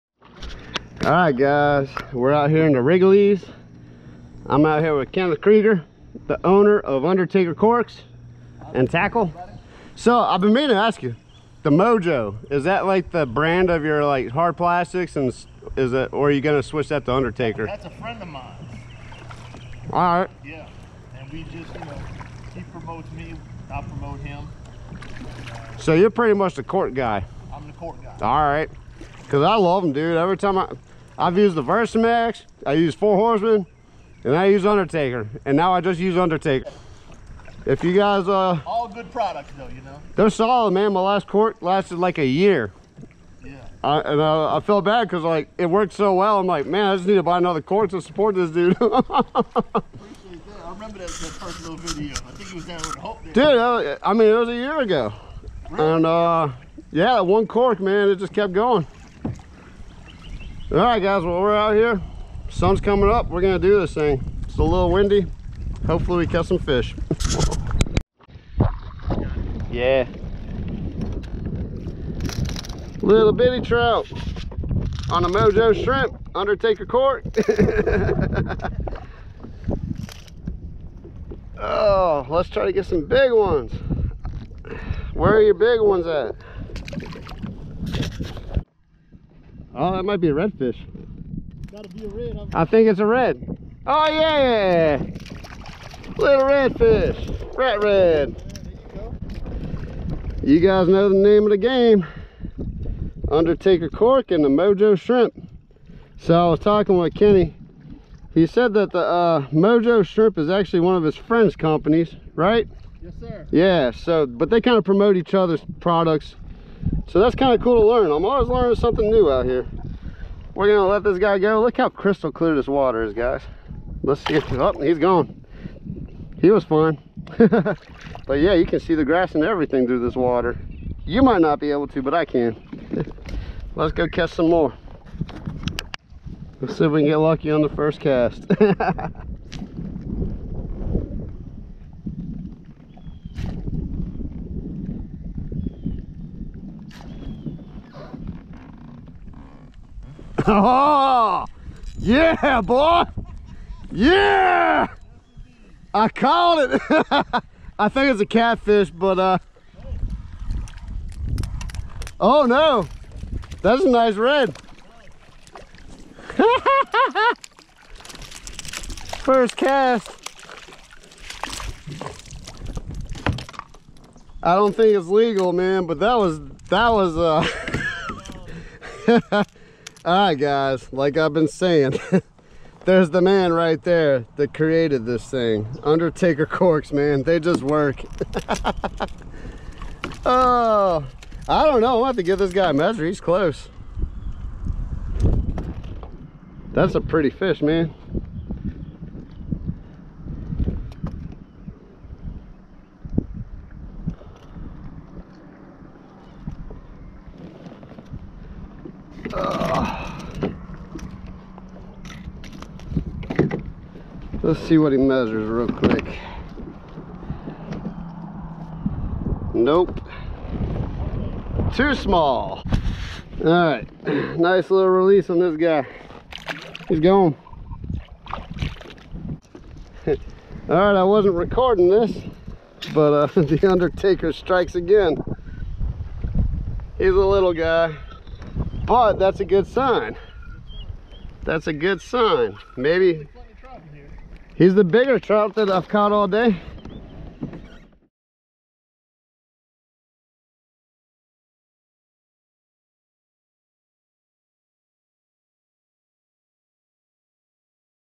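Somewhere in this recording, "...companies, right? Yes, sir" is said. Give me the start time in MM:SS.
01:51.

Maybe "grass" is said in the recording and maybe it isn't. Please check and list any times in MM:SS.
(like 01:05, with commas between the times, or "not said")
02:09.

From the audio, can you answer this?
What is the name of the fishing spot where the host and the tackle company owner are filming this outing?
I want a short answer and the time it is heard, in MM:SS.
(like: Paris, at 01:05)
Rigolets, at 00:02.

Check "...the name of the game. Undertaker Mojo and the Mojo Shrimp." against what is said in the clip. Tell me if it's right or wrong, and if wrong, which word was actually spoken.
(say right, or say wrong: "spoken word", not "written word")
wrong: "Cork", not "Mojo".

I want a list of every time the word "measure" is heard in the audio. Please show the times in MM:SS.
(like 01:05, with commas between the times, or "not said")
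03:12, 03:34.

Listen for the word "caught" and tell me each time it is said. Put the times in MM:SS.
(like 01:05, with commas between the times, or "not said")
02:36, 04:05.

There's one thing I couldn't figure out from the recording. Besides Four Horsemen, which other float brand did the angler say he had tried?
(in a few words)
Versamax.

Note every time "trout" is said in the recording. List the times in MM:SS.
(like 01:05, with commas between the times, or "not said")
01:13, 04:05.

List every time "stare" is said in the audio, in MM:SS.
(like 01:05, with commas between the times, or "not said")
not said.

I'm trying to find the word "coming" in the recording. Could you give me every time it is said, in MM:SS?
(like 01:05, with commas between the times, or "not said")
01:02.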